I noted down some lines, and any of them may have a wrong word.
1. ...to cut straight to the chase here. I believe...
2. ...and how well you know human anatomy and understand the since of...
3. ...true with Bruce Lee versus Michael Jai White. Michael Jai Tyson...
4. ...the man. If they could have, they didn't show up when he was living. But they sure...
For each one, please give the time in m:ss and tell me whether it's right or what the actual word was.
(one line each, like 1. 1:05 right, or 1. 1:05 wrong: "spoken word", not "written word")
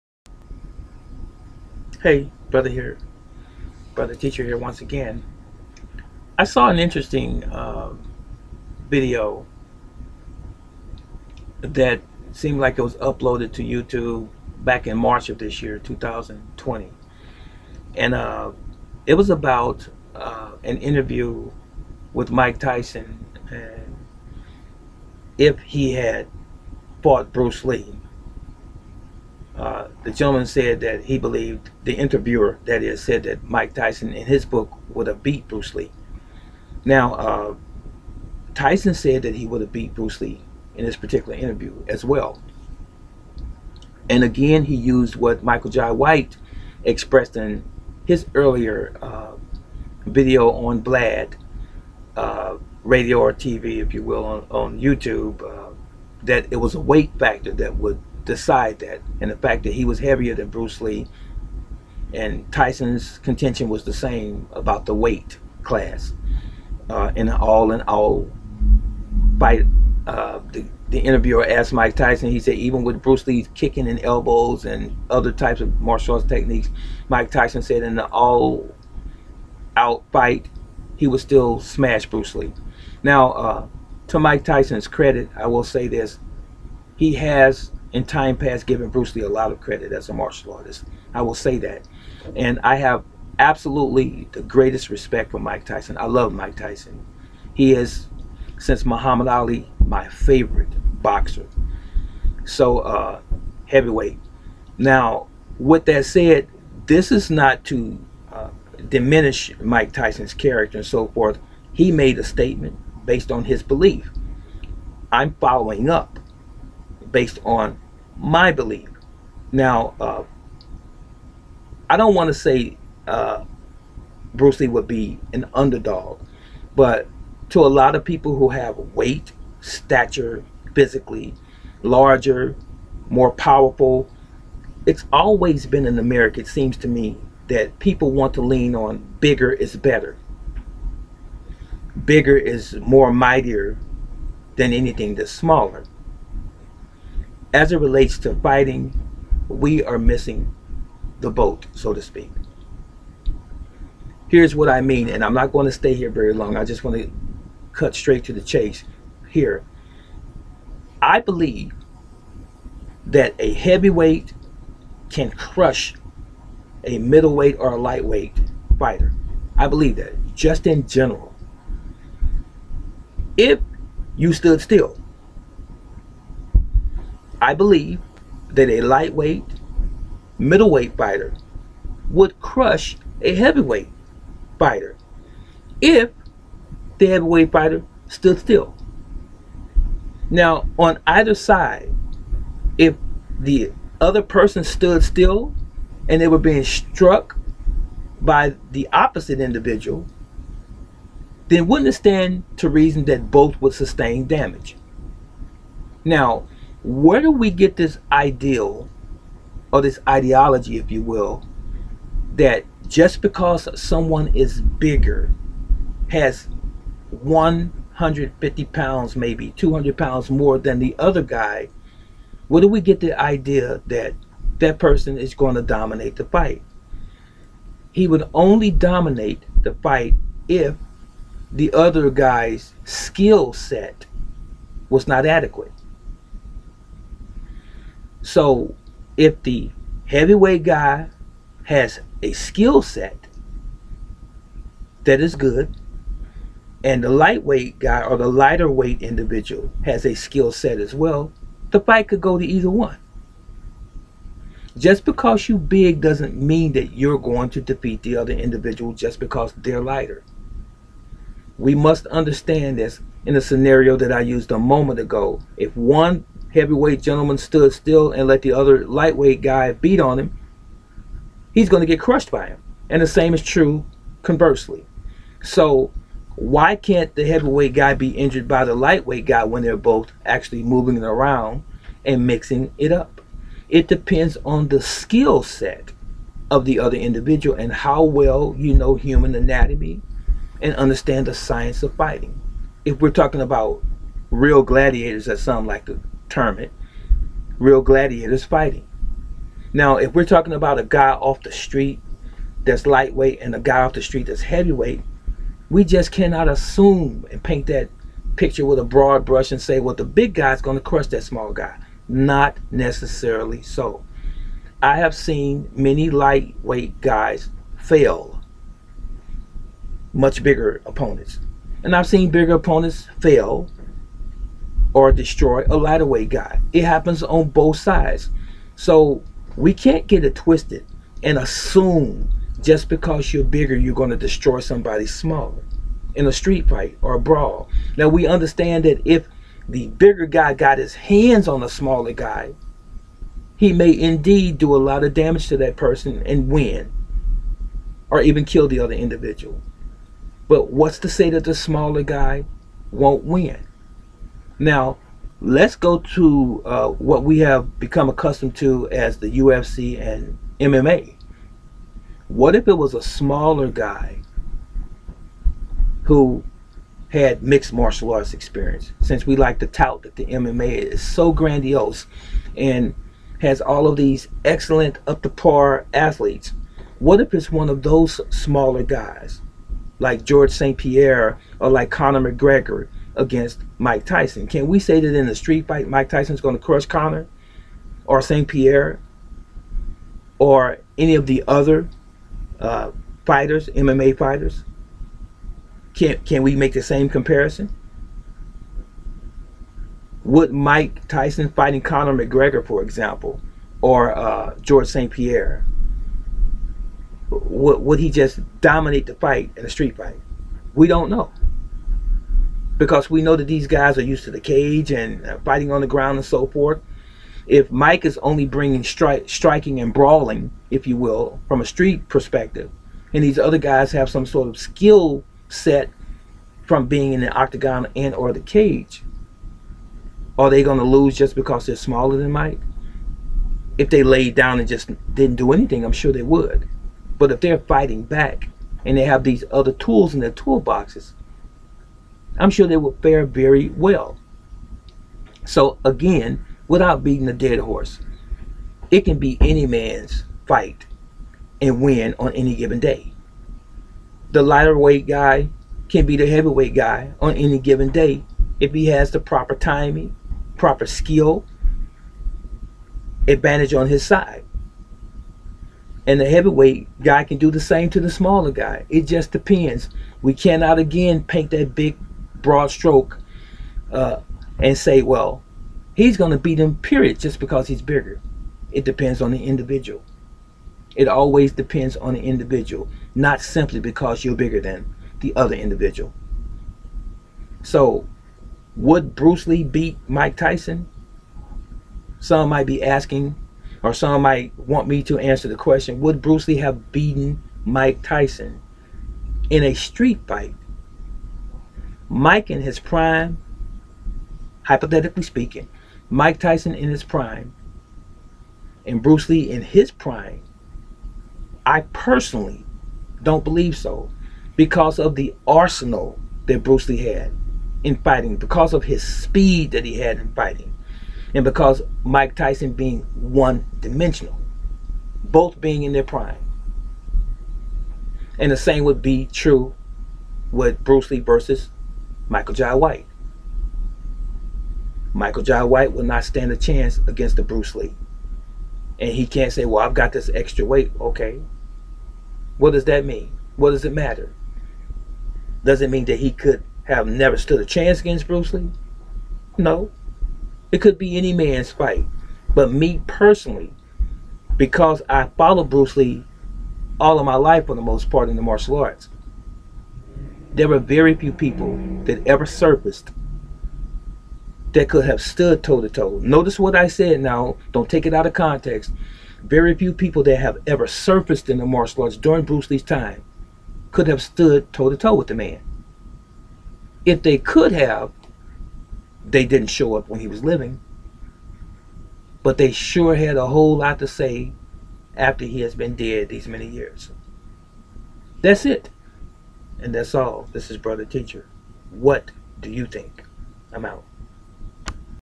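1. 2:36 right
2. 4:47 wrong: "science", not "since"
3. 8:49 wrong: "White", not "Tyson"
4. 9:35 right.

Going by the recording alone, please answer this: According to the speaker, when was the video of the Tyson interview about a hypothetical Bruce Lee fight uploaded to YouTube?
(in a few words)
March 2020.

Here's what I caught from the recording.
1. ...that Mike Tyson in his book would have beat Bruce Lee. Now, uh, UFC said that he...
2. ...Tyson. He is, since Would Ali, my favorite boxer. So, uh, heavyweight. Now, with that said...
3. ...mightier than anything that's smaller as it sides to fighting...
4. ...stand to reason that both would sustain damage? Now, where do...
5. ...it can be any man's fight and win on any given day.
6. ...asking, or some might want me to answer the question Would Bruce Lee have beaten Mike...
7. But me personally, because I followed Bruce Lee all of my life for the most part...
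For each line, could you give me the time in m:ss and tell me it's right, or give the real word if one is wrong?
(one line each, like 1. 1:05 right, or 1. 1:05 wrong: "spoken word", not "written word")
1. 0:33 wrong: "Tyson", not "UFC"
2. 1:36 wrong: "Muhammad", not "Would"
3. 2:23 wrong: "relates", not "sides"
4. 3:21 right
5. 7:28 right
6. 8:12 right
7. 9:12 right.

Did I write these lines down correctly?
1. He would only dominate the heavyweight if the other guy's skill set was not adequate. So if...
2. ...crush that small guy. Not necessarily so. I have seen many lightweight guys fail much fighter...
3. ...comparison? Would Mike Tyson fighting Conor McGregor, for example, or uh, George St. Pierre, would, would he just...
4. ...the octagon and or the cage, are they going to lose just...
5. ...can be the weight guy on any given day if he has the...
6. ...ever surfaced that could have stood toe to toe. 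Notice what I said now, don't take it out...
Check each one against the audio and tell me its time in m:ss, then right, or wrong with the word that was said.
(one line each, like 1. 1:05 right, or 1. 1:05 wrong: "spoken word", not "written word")
1. 3:47 wrong: "fight", not "heavyweight"
2. 5:10 wrong: "bigger", not "fighter"
3. 6:37 right
4. 7:07 right
5. 7:35 wrong: "heavyweight", not "weight"
6. 9:22 right.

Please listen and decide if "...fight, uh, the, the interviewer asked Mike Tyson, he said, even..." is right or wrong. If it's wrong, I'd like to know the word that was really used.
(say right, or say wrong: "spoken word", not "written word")
right.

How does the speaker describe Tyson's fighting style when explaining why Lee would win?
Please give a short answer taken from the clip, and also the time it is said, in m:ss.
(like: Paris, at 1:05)
one dimensional, at 8:43.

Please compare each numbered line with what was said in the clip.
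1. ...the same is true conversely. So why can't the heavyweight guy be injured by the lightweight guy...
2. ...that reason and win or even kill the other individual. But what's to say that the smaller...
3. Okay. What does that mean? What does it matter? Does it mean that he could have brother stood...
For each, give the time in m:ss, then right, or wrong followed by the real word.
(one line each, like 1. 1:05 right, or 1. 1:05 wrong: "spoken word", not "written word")
1. 4:33 right
2. 5:45 wrong: "person", not "reason"
3. 9:01 wrong: "never", not "brother".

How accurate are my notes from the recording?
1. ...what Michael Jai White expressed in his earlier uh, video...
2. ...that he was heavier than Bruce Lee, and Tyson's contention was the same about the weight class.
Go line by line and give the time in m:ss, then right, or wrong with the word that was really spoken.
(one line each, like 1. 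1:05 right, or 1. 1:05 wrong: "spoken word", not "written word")
1. 0:45 right
2. 0:59 right.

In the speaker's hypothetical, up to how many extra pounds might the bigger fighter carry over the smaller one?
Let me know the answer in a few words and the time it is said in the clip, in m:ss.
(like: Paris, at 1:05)
200 pounds, at 3:39.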